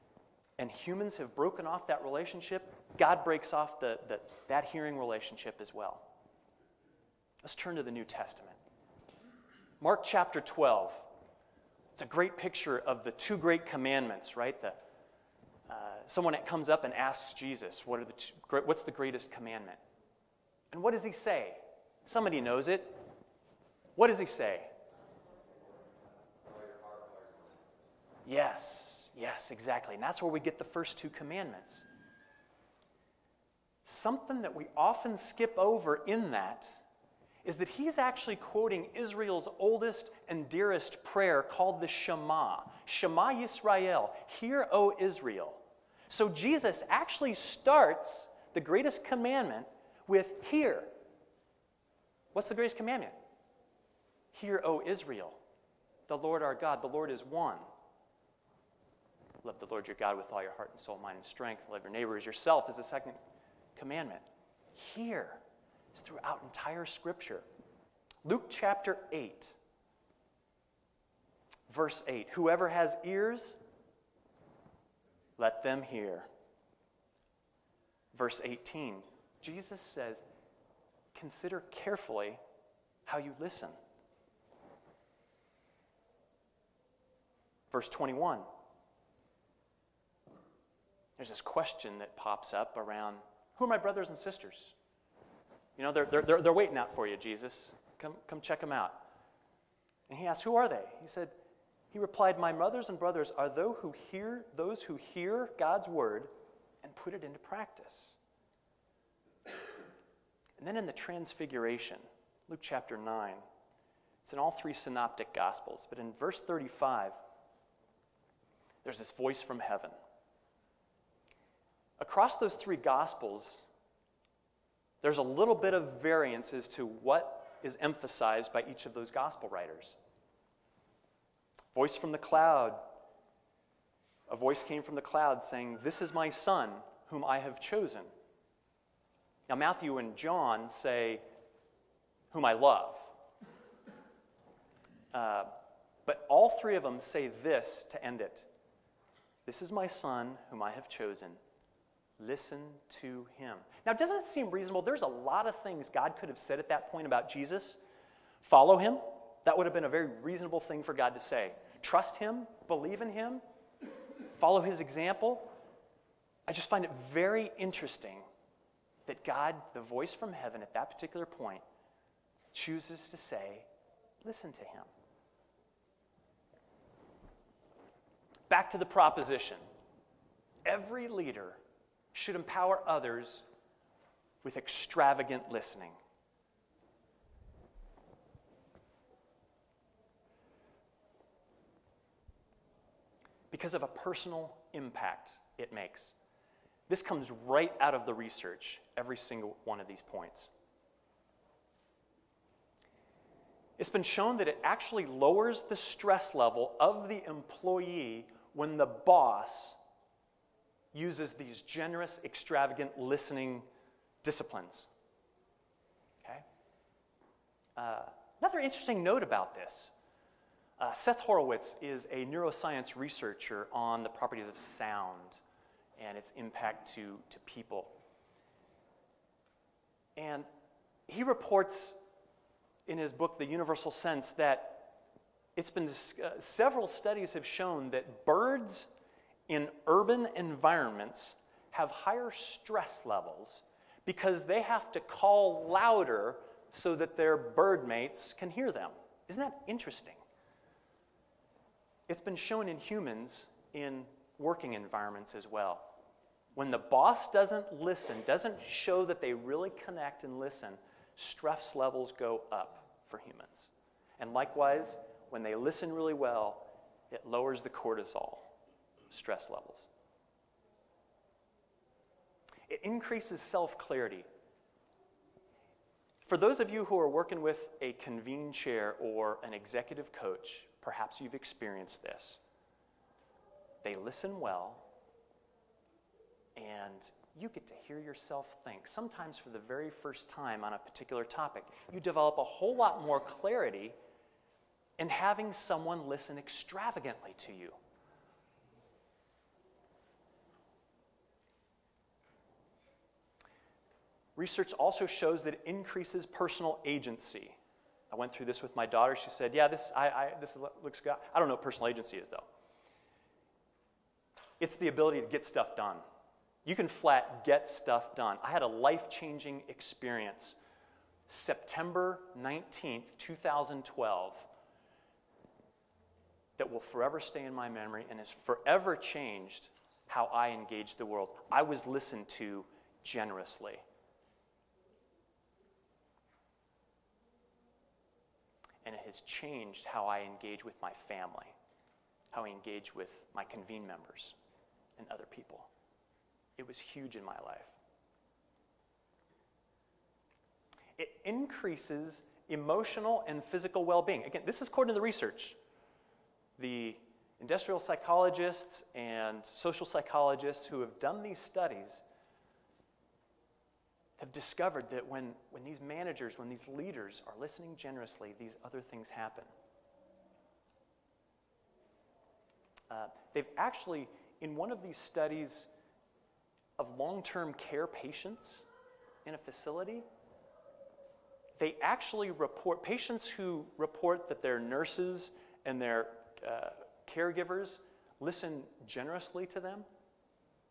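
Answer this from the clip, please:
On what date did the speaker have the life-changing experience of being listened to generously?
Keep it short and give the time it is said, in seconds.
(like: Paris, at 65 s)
September 19th, 2012, at 321 s.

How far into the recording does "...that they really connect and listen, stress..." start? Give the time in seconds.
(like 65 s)
259 s.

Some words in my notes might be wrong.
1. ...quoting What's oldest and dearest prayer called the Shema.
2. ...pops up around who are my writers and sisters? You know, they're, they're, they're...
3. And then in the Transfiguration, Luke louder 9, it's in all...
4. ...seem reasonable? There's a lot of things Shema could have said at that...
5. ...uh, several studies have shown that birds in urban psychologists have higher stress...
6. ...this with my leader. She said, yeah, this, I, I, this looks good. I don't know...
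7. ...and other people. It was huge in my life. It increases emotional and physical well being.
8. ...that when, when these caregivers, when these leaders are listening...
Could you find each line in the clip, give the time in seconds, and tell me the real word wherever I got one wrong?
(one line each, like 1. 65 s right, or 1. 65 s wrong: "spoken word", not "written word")
1. 38 s wrong: "Israel", not "What"
2. 92 s wrong: "brothers", not "writers"
3. 110 s wrong: "chapter", not "louder"
4. 154 s wrong: "God", not "Shema"
5. 235 s wrong: "environments", not "psychologists"
6. 308 s wrong: "daughter", not "leader"
7. 344 s right
8. 364 s wrong: "managers", not "caregivers".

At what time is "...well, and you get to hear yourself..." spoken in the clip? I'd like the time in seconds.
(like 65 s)
284 s.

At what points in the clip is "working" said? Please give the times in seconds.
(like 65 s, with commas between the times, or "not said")
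254 s, 277 s.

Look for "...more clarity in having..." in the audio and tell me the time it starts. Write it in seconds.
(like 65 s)
293 s.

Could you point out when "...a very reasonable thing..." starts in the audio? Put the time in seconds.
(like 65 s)
159 s.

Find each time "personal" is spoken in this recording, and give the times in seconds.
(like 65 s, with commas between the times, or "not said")
193 s, 306 s, 311 s.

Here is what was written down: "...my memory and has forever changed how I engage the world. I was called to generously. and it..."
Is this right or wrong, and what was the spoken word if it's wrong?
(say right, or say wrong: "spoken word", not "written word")
wrong: "listened", not "called".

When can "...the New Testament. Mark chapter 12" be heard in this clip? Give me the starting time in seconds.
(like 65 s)
7 s.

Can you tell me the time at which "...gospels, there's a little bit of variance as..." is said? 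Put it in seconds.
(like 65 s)
122 s.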